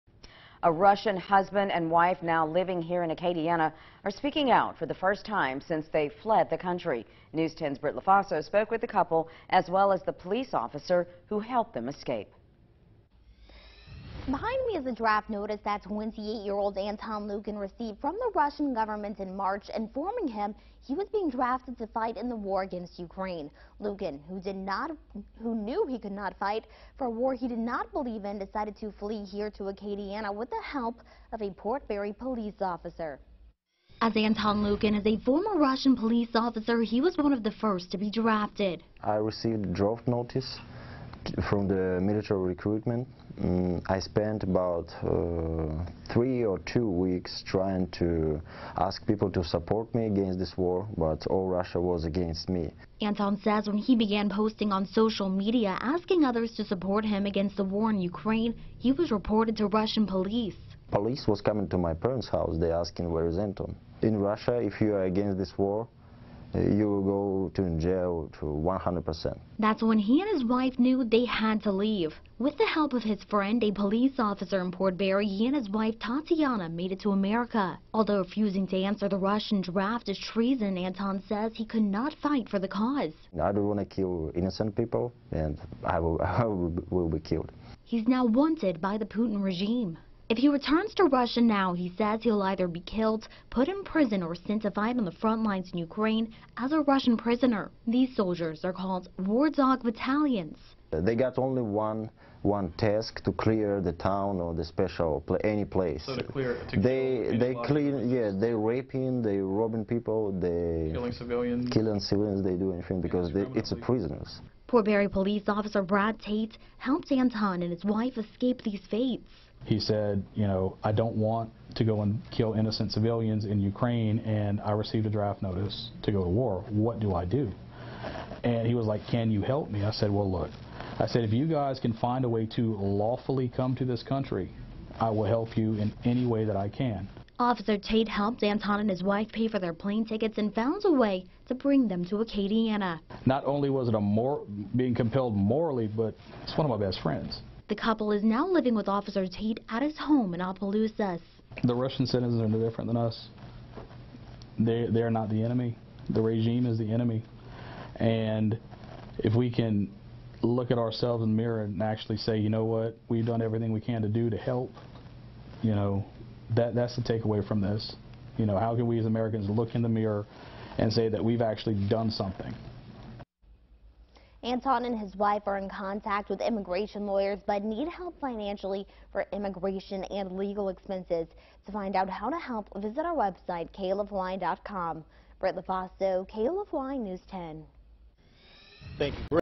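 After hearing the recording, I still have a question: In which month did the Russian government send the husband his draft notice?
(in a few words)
March.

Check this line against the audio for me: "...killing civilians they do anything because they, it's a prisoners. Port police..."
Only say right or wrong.
right.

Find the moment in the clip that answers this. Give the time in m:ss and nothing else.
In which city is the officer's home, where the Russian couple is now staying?
2:30.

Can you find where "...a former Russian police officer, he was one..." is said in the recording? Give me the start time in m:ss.
0:35.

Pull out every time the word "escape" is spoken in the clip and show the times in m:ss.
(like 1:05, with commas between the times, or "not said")
0:11, 1:58.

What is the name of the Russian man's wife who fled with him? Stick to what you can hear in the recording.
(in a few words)
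Tatiana.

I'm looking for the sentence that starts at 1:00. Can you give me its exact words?
Police was coming to my parents' house.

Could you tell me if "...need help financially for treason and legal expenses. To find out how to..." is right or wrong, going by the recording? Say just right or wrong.
wrong.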